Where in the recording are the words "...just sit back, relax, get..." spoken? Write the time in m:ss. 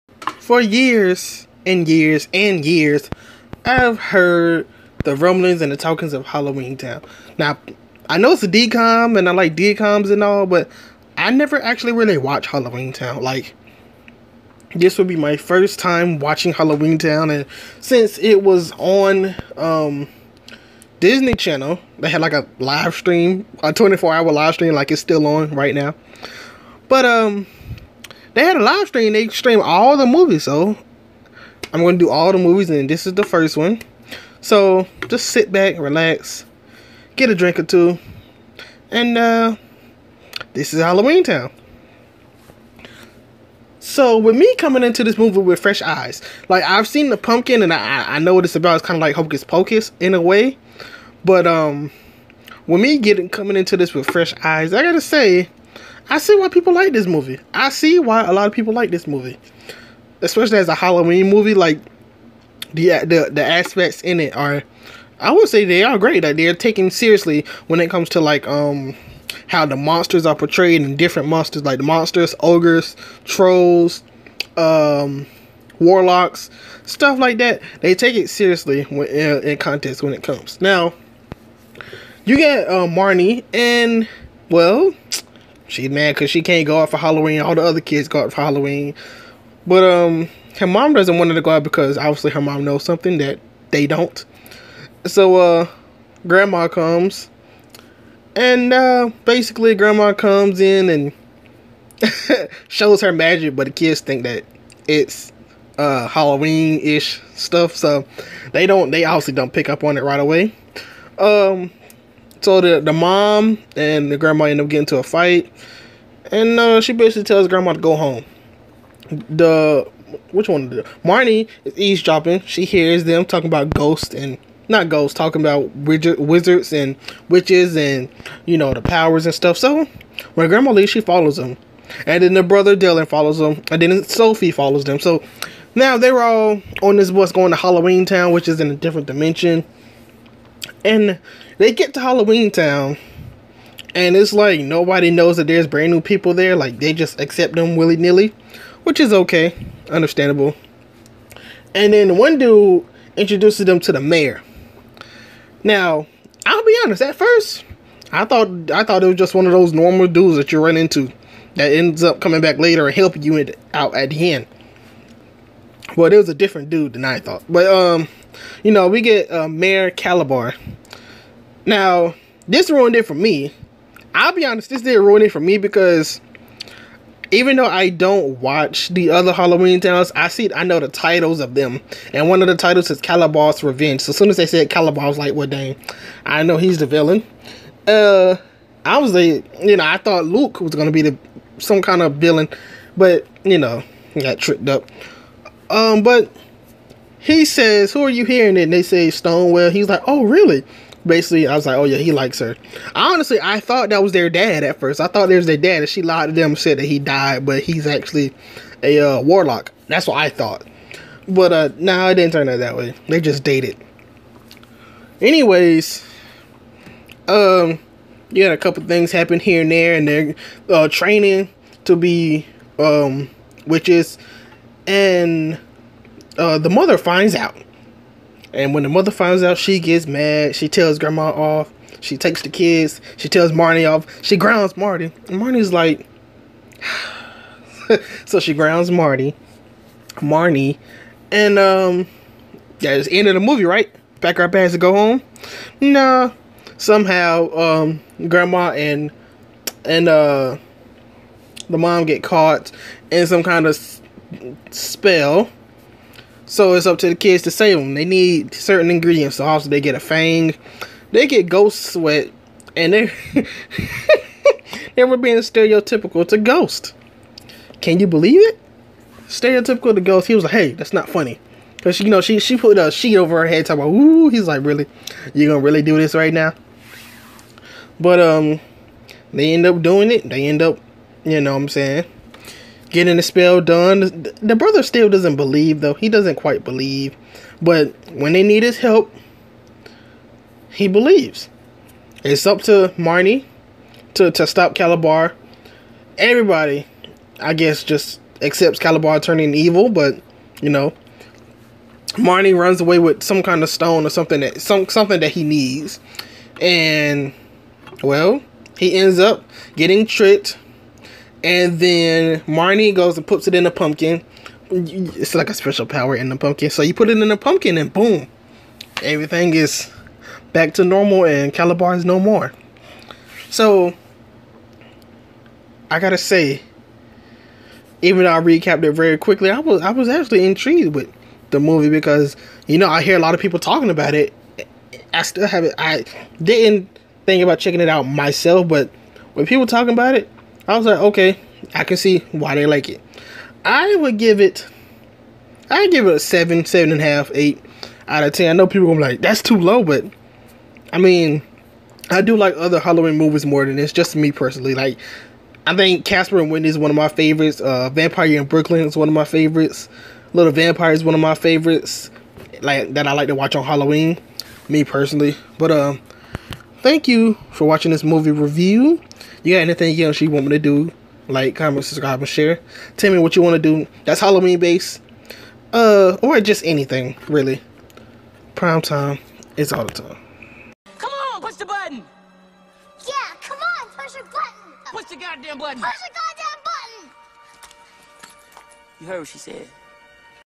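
0:35.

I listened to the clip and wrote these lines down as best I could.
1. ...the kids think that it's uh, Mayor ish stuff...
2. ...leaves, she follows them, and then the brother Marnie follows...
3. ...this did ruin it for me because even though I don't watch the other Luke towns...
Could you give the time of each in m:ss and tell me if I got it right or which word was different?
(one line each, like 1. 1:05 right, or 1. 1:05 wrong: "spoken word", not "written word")
1. 1:43 wrong: "Halloween", not "Mayor"
2. 2:10 wrong: "Dylan", not "Marnie"
3. 2:54 wrong: "Halloween", not "Luke".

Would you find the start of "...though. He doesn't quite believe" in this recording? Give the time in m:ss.
4:45.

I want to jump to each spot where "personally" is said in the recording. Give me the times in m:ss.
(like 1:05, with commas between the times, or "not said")
5:54, 6:04.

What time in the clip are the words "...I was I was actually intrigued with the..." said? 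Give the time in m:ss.
5:29.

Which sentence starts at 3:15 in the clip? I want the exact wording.
Um, but he says, Who are you hearing?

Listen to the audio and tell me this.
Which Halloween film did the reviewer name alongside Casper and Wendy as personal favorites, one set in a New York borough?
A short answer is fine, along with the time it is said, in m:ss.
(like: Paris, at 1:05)
Vampire in Brooklyn, at 5:57.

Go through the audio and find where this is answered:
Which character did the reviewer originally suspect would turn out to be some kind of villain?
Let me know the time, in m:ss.
3:10.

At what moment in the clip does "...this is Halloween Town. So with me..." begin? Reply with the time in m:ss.
0:40.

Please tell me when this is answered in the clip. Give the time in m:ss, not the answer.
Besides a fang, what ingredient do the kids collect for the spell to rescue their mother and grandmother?
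4:21.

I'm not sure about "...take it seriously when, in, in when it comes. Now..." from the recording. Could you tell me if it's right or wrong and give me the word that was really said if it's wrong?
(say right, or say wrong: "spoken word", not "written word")
right.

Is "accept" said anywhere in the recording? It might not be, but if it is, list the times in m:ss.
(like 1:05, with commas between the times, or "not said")
2:27, 4:58.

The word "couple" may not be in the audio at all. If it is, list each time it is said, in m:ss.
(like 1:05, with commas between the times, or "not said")
3:38.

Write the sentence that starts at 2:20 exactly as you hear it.
And they get to Halloween Town, and it's like nobody knows that there's brand new people there.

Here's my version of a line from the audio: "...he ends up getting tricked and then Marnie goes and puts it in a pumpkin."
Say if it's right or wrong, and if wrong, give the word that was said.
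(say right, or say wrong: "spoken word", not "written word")
right.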